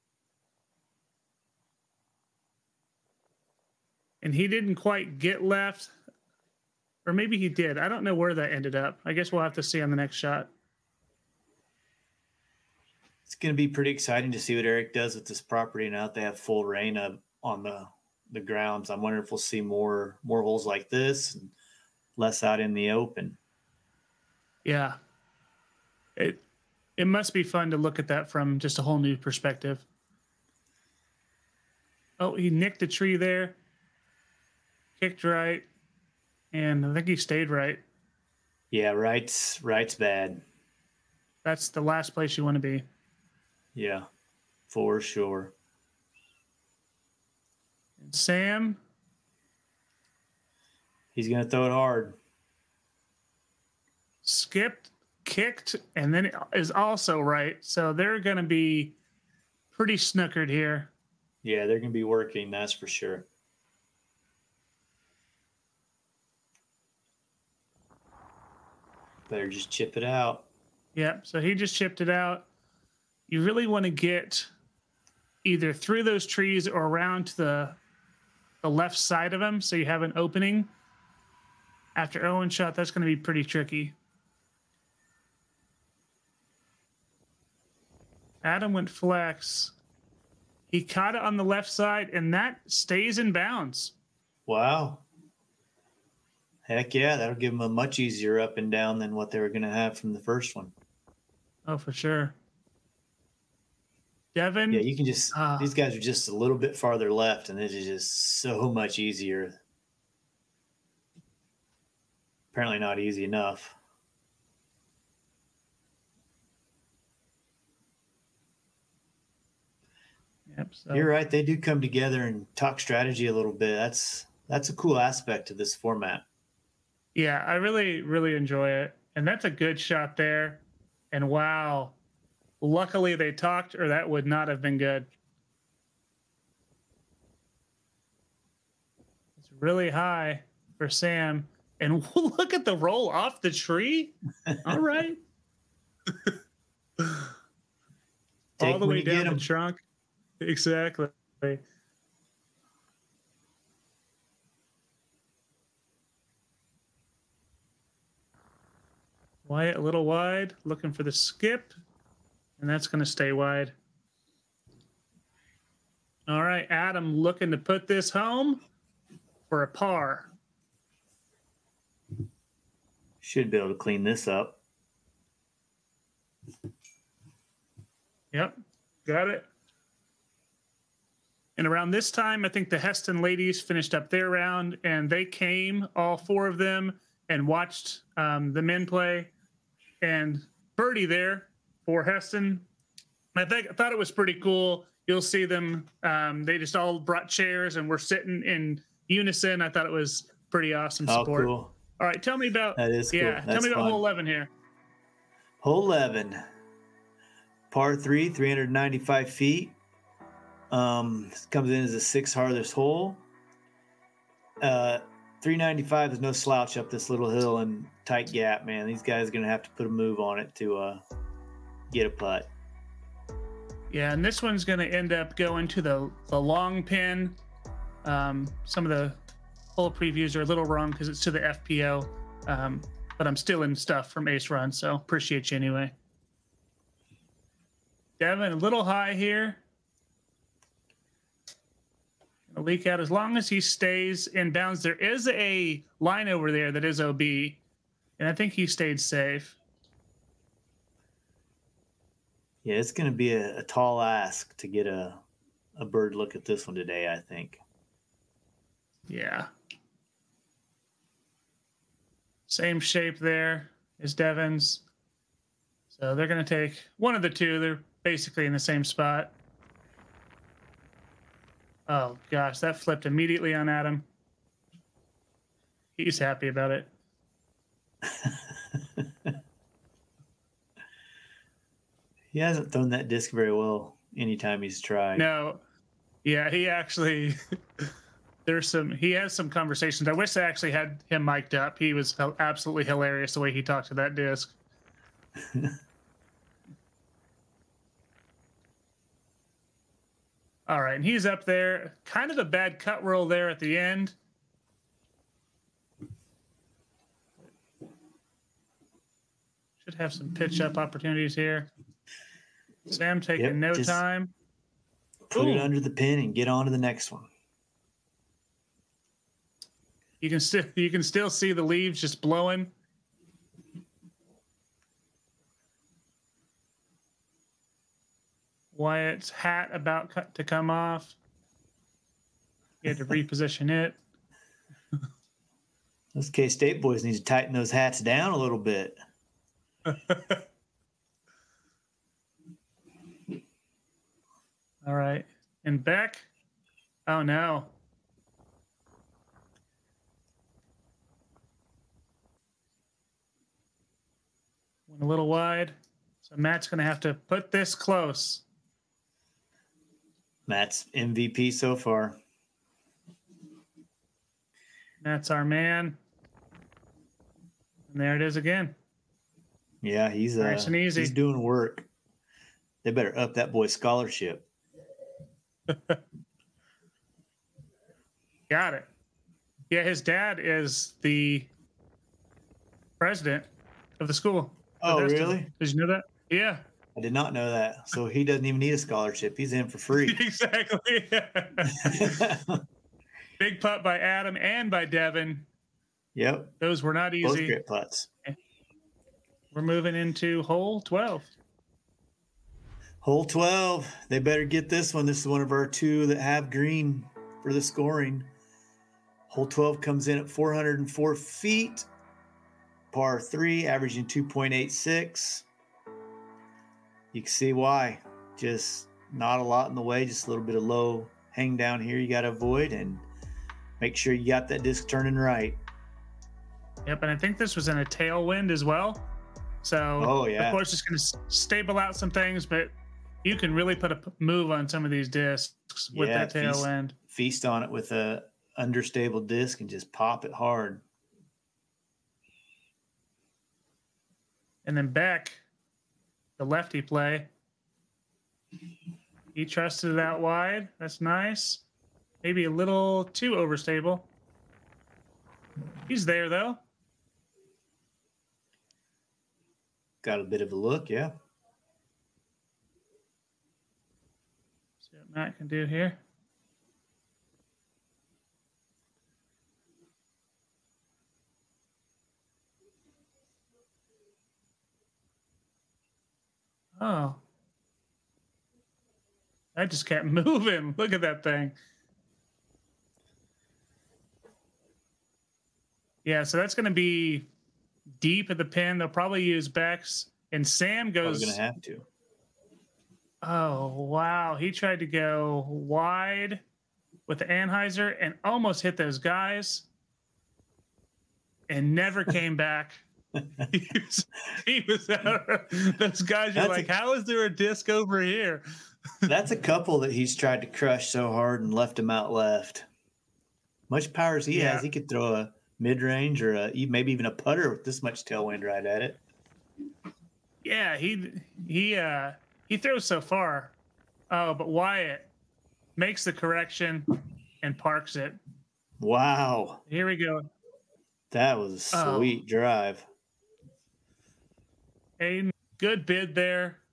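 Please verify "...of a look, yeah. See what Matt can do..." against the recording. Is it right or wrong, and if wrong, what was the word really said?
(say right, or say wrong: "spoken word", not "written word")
right.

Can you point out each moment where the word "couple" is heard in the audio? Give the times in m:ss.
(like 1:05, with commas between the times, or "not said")
8:29.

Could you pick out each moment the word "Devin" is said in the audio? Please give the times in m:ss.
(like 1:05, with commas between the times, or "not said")
1:44, 3:58, 4:24, 6:34.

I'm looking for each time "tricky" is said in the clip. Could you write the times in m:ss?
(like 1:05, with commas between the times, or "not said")
1:23.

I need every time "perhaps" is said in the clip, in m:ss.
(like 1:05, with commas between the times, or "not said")
not said.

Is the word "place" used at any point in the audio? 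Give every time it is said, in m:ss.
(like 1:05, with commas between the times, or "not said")
0:42.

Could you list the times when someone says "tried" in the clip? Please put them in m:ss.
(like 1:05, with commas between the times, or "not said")
4:44, 8:14, 8:30.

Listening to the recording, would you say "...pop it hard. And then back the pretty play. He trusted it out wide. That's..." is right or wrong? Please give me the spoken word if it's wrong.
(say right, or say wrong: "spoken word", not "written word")
wrong: "lefty", not "pretty".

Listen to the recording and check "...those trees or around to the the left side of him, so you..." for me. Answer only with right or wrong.
right.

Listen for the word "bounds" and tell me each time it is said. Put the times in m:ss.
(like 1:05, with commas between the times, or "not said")
1:33, 4:04.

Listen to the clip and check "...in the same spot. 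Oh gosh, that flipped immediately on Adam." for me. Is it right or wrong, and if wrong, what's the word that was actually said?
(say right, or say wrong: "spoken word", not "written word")
right.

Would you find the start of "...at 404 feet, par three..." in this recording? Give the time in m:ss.
6:50.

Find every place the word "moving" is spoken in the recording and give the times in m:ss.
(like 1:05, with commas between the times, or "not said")
6:39, 8:00.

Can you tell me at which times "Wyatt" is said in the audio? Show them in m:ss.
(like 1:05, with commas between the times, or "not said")
2:39, 5:28, 8:44.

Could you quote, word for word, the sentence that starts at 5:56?
So Matt's going to have to put this close.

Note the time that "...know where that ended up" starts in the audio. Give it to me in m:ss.
0:08.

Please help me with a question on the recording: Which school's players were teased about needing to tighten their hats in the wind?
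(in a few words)
K State.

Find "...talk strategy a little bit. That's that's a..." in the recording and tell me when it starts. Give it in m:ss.
2:02.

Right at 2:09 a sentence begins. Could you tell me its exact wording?
And that's a good shot there.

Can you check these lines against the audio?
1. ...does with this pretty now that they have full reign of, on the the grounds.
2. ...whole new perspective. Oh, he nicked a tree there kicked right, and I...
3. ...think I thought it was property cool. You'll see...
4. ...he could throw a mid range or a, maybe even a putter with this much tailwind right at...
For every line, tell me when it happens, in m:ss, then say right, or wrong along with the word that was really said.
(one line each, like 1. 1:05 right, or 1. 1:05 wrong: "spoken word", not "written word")
1. 0:14 wrong: "property", not "pretty"
2. 0:28 right
3. 3:13 wrong: "pretty", not "property"
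4. 8:34 right.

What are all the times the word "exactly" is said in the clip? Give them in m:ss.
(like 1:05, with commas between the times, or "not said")
2:30, 6:30.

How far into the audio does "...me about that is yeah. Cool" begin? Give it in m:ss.
3:22.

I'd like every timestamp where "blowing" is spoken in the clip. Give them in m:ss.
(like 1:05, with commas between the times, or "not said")
5:22.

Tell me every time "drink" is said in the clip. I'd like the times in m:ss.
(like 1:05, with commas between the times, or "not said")
not said.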